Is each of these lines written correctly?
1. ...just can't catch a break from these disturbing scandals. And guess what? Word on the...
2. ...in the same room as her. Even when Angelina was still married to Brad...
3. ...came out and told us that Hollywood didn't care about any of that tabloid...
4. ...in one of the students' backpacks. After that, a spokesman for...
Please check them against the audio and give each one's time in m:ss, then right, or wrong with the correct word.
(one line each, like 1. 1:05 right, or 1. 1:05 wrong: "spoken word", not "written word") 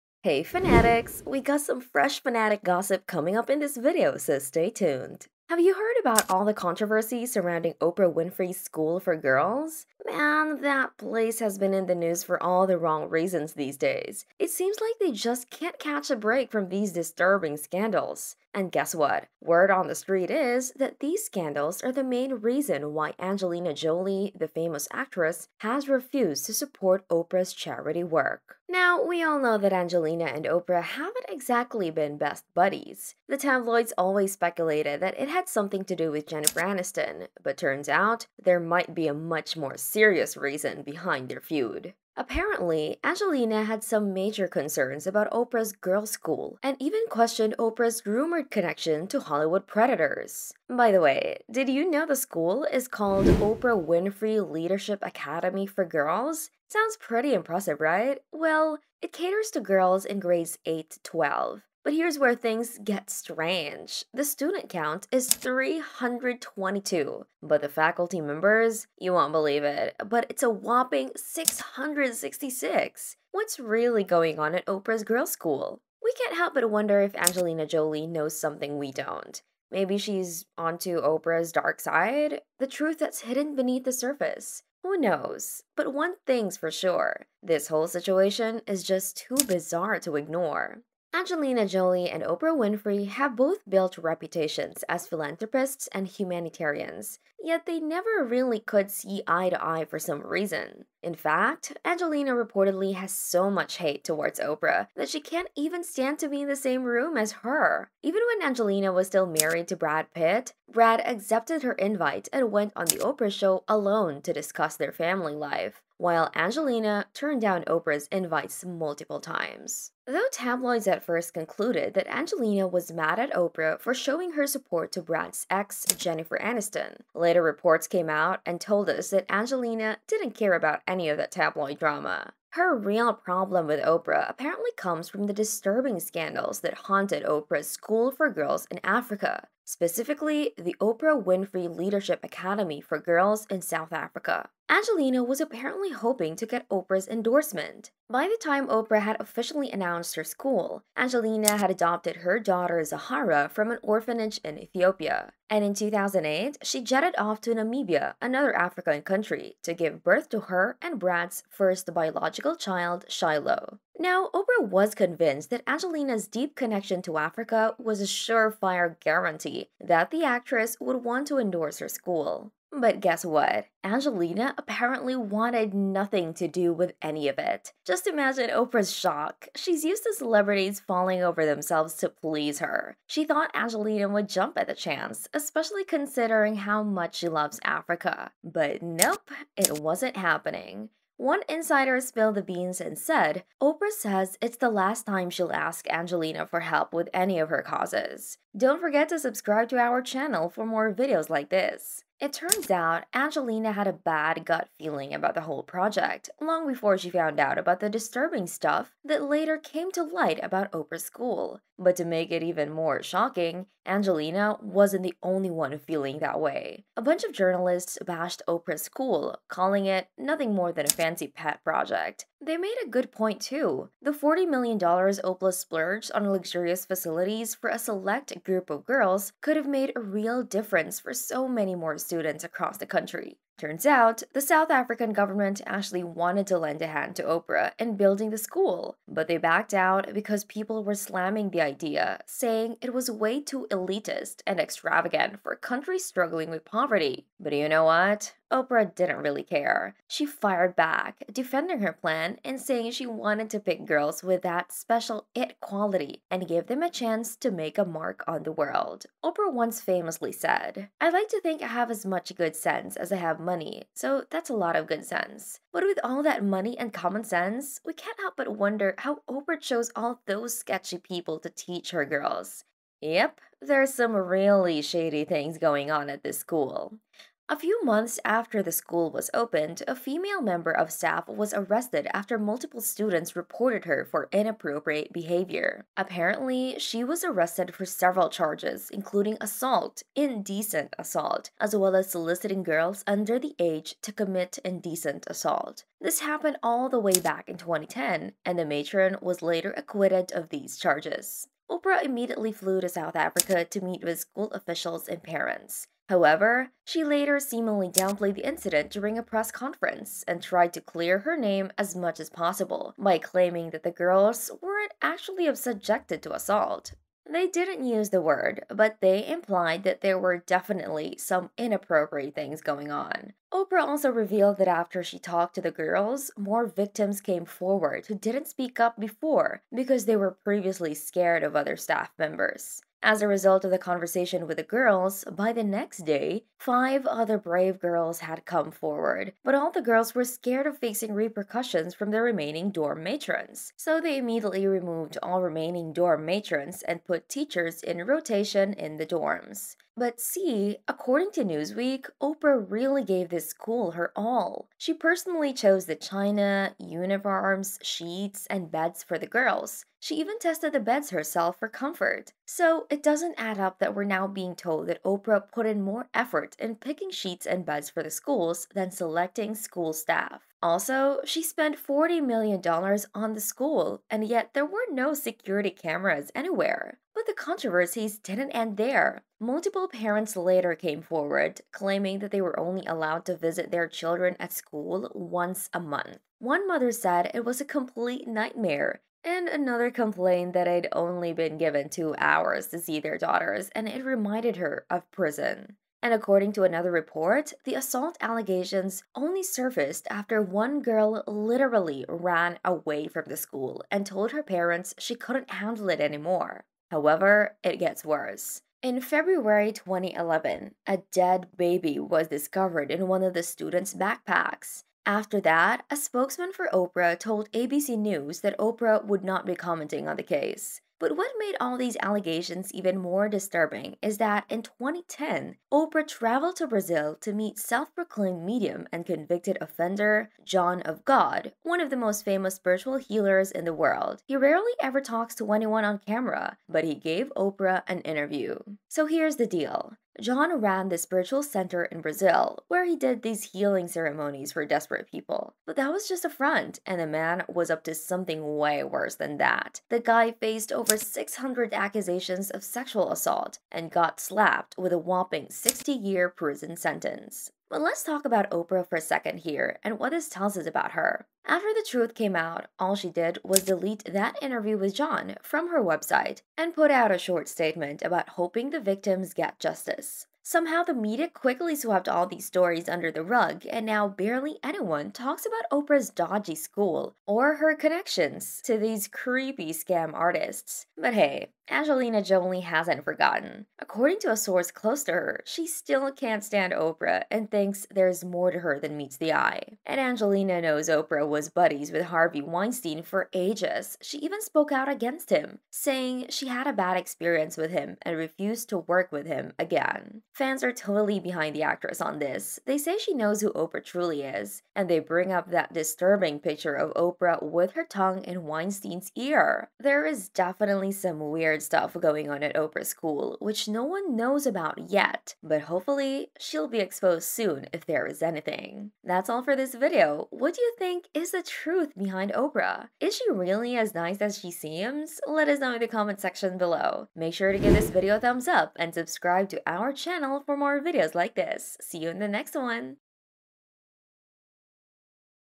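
1. 0:15 right
2. 1:46 right
3. 2:07 wrong: "Angelina", not "Hollywood"
4. 6:52 right.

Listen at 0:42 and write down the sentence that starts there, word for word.
Apparently, Angelina had some major concerns about Oprah's girl school and even questioned Oprah's rumored connection to Hollywood predators.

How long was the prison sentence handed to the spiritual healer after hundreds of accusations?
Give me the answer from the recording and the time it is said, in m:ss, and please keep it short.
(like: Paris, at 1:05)
60 years, at 7:35.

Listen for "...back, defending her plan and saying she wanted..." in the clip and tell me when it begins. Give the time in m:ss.
4:10.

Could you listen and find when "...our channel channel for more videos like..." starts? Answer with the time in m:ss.
8:49.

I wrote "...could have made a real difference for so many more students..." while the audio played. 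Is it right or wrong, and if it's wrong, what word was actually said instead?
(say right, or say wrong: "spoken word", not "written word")
right.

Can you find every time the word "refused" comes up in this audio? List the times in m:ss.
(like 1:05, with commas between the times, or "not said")
0:25, 8:18.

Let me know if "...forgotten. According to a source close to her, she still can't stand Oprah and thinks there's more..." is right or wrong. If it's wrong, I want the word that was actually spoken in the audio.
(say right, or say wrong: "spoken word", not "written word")
right.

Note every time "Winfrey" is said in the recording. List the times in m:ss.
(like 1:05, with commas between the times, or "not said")
0:08, 0:53, 1:32, 2:21.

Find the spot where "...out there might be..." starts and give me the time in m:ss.
0:37.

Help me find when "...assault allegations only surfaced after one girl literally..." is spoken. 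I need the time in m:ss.
6:37.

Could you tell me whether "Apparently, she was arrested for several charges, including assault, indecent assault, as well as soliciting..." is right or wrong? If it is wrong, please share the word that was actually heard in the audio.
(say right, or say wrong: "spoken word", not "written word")
right.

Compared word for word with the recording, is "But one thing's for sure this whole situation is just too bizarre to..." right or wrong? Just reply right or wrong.
right.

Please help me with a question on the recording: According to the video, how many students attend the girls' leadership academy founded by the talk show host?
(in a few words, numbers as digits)
322.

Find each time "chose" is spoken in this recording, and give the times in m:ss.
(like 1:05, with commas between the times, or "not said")
4:29, 5:55.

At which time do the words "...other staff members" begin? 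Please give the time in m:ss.
5:31.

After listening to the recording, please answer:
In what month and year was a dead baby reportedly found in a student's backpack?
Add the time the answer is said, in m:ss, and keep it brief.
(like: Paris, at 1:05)
February 2011, at 6:48.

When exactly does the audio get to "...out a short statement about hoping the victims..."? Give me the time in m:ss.
7:46.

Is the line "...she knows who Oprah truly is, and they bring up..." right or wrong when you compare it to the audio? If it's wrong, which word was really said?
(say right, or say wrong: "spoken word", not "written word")
right.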